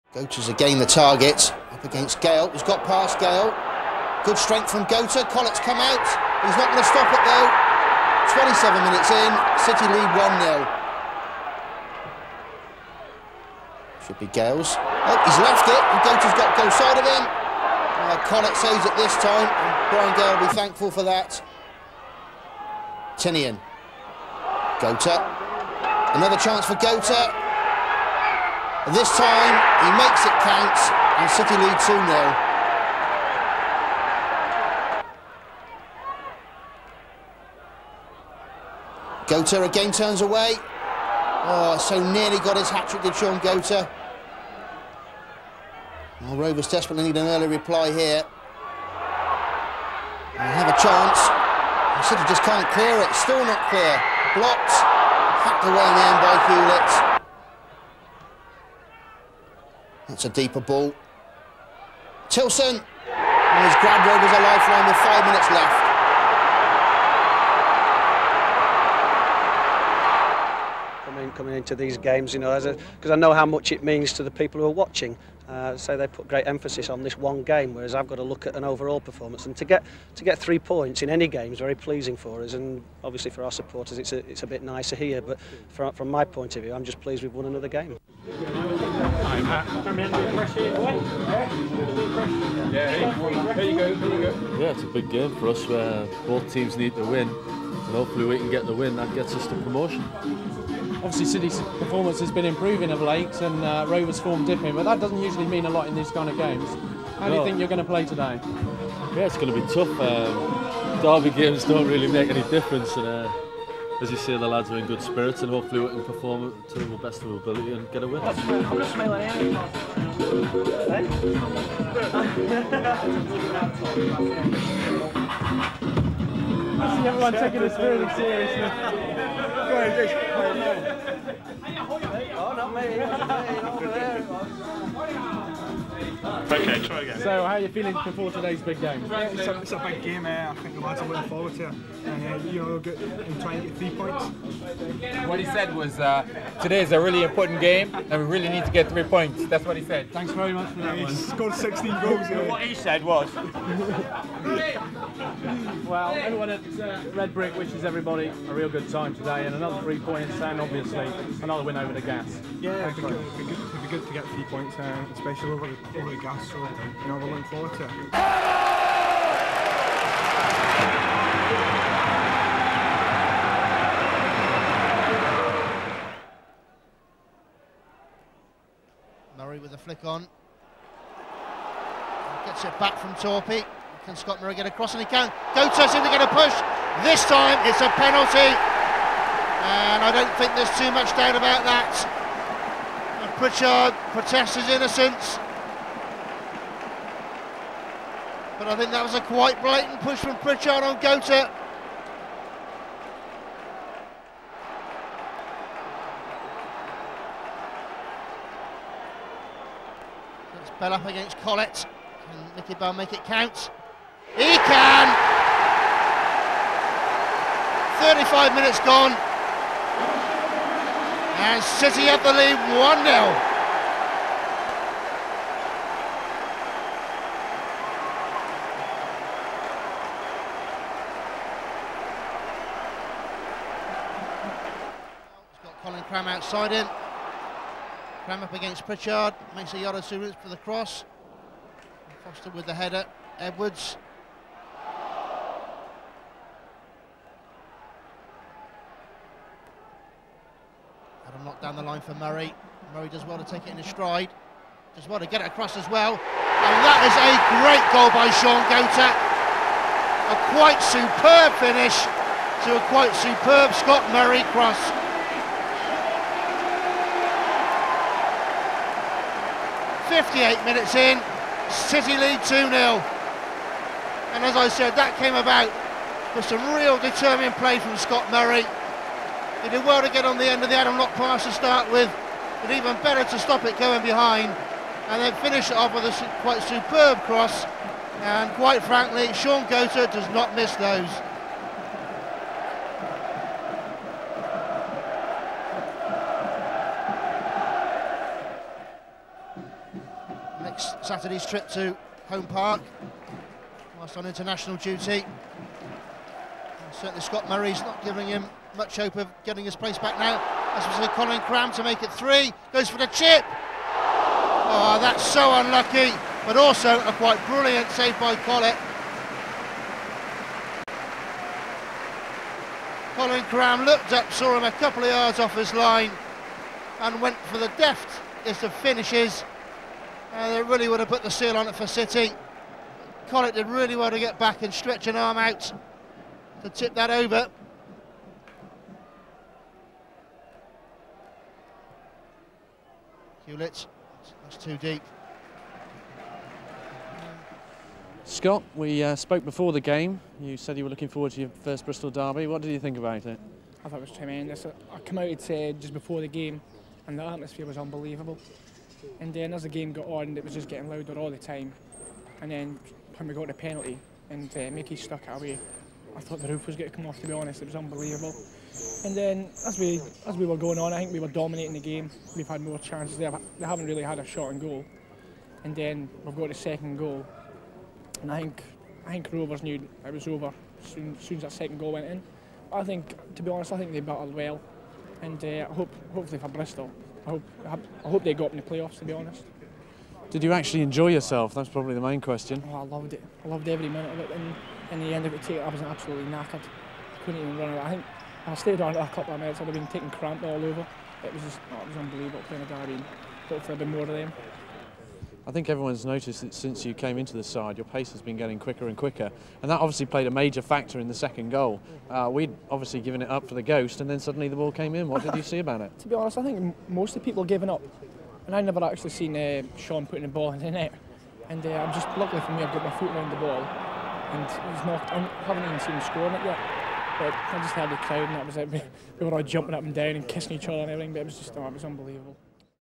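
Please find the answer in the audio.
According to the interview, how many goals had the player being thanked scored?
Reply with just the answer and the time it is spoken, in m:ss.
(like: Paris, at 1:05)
16, at 2:31.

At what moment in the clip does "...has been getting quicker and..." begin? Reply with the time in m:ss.
6:48.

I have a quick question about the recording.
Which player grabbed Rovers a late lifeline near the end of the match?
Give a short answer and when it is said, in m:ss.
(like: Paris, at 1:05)
Tilson, at 1:02.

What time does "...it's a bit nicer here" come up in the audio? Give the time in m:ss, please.
1:24.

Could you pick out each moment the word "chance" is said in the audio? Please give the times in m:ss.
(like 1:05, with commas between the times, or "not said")
0:26, 0:50, 6:12.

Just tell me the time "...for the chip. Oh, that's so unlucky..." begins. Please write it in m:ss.
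5:12.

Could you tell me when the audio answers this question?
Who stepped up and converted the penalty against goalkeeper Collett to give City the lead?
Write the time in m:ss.
3:32.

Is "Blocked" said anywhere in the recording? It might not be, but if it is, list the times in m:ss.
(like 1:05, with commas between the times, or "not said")
0:54.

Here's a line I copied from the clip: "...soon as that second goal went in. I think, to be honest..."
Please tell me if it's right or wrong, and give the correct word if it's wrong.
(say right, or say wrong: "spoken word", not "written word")
right.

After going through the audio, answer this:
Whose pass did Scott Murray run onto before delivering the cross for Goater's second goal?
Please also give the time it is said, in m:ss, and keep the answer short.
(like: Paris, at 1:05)
Adam Locke, at 4:40.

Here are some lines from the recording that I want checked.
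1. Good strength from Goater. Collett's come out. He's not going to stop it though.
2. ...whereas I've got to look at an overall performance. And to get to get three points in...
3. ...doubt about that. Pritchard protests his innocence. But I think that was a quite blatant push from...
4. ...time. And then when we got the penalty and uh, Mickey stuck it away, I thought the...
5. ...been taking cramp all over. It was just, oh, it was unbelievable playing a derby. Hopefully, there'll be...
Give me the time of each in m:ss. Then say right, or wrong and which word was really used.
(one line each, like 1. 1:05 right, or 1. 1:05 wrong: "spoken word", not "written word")
1. 0:04 right
2. 1:17 right
3. 3:11 right
4. 6:01 right
5. 6:39 right.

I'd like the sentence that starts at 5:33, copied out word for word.
Collett did really well to get back and stretch an arm out to tip that over.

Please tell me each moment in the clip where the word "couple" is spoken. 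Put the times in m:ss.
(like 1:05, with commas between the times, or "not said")
5:24, 6:39.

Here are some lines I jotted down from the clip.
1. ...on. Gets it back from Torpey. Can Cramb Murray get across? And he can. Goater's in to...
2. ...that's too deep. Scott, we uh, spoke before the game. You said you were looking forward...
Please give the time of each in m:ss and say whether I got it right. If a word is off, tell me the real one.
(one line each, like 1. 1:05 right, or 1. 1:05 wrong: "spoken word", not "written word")
1. 3:00 wrong: "Scott", not "Cramb"
2. 5:44 right.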